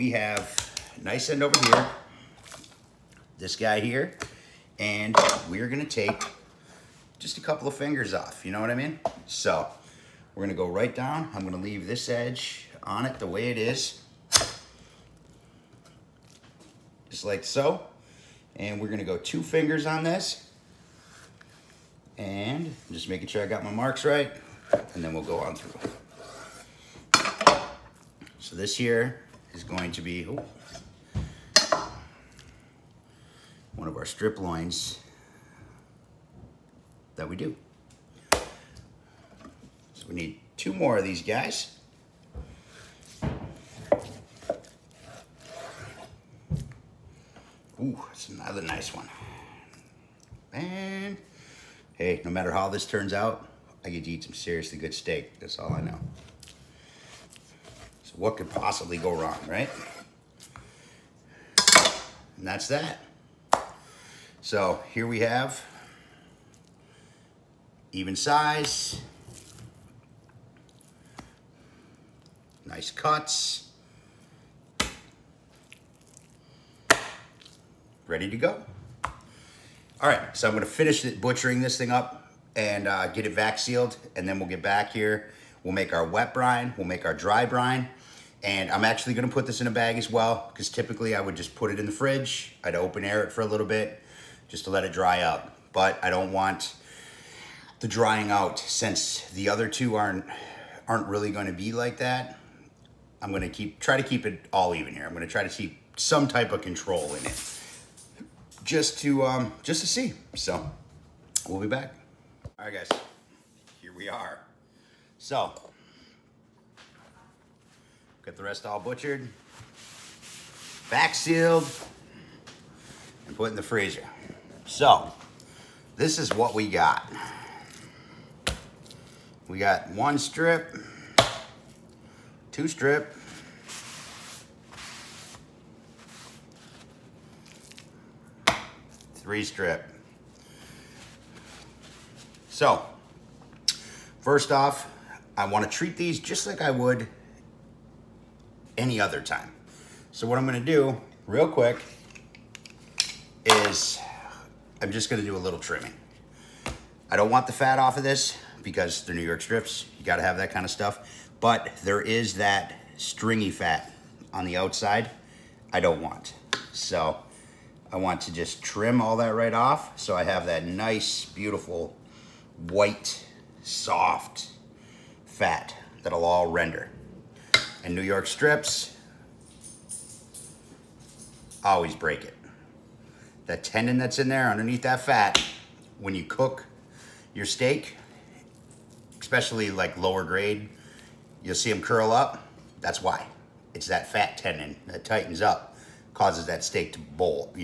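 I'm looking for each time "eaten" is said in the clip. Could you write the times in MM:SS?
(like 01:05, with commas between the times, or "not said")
not said.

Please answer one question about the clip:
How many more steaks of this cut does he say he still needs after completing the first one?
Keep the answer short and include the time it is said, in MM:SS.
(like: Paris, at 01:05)
2, at 00:40.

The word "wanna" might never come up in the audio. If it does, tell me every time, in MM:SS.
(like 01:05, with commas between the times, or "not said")
02:25.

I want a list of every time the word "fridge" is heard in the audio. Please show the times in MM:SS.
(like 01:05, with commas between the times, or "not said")
01:31.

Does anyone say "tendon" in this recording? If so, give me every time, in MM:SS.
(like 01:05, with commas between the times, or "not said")
03:03, 03:14.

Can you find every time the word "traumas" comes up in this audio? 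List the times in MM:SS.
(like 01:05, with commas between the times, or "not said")
not said.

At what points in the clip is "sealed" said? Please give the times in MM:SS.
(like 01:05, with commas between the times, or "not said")
01:23, 02:01.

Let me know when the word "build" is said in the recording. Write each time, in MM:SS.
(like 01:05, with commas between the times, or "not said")
not said.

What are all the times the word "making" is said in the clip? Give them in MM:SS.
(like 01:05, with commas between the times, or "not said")
00:23.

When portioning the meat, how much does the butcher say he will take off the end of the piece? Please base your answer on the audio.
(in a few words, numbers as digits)
2 fingers.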